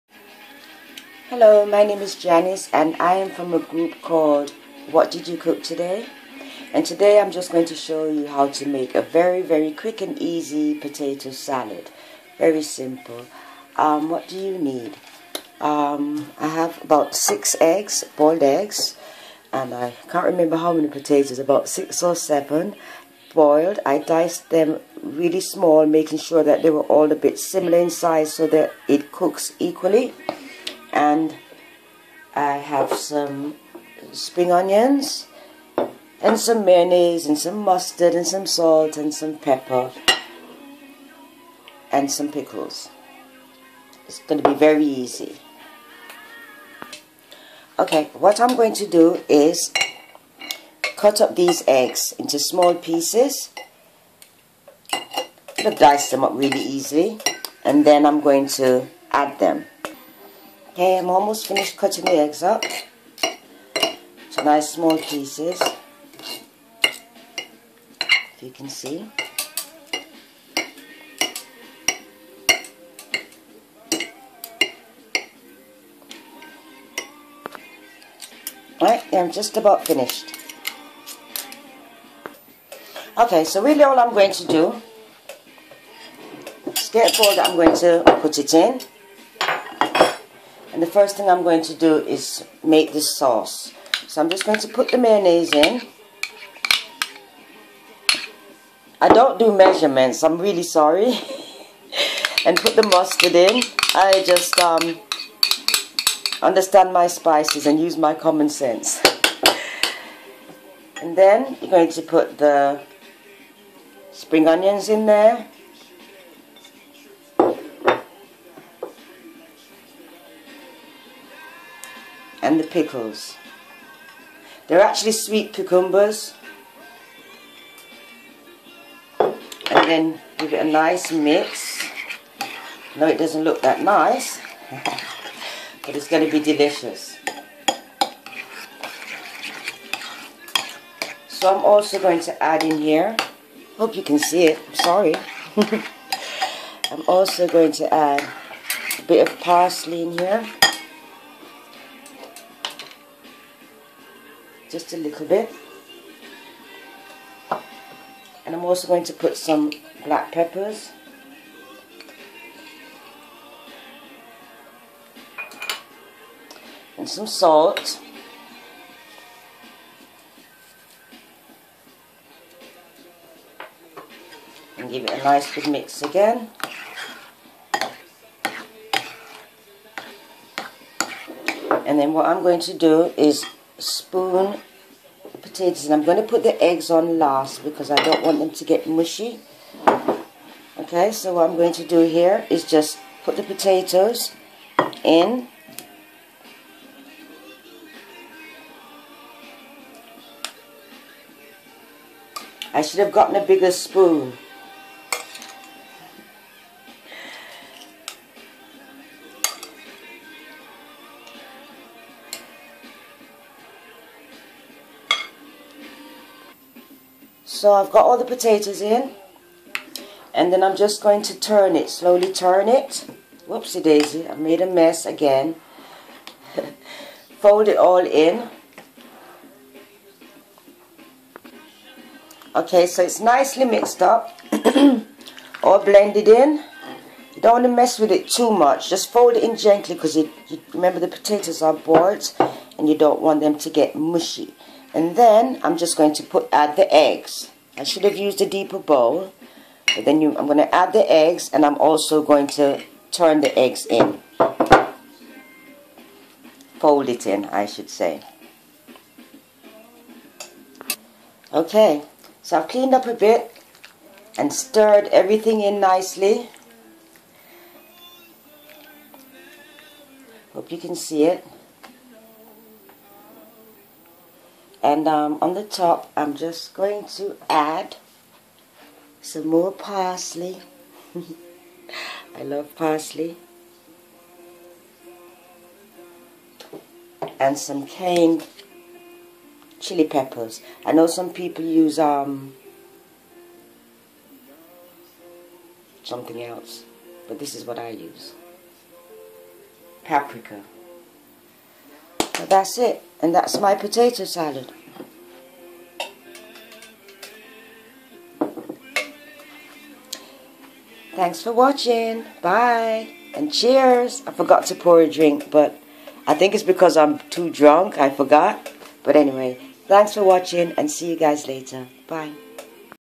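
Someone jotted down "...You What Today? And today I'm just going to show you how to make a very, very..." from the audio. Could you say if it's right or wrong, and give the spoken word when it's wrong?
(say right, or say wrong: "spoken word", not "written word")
wrong: "Cook", not "What".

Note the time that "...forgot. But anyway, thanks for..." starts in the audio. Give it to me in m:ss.
5:18.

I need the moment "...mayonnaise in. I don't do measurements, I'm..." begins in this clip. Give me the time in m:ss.
1:34.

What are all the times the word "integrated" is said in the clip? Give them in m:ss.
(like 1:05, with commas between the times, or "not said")
not said.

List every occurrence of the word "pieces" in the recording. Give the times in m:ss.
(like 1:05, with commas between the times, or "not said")
0:52, 1:04.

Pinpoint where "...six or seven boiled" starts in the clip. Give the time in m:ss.
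0:21.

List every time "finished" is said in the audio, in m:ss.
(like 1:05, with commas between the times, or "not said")
1:01, 1:19.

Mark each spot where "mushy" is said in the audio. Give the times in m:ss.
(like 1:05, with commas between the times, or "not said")
3:08, 4:03.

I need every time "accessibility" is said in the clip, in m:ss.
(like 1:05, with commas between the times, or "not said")
not said.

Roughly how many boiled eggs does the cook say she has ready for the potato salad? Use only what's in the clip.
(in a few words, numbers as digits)
6.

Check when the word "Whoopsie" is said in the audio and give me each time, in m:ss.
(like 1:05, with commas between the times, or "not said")
3:43.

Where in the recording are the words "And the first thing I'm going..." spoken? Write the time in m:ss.
1:30.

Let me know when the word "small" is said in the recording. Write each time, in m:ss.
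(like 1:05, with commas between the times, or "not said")
0:25, 0:52, 1:04.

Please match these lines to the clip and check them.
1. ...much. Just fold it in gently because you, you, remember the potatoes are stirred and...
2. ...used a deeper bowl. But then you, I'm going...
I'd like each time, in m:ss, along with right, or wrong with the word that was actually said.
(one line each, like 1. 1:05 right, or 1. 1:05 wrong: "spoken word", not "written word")
1. 3:58 wrong: "boiled", not "stirred"
2. 4:08 right.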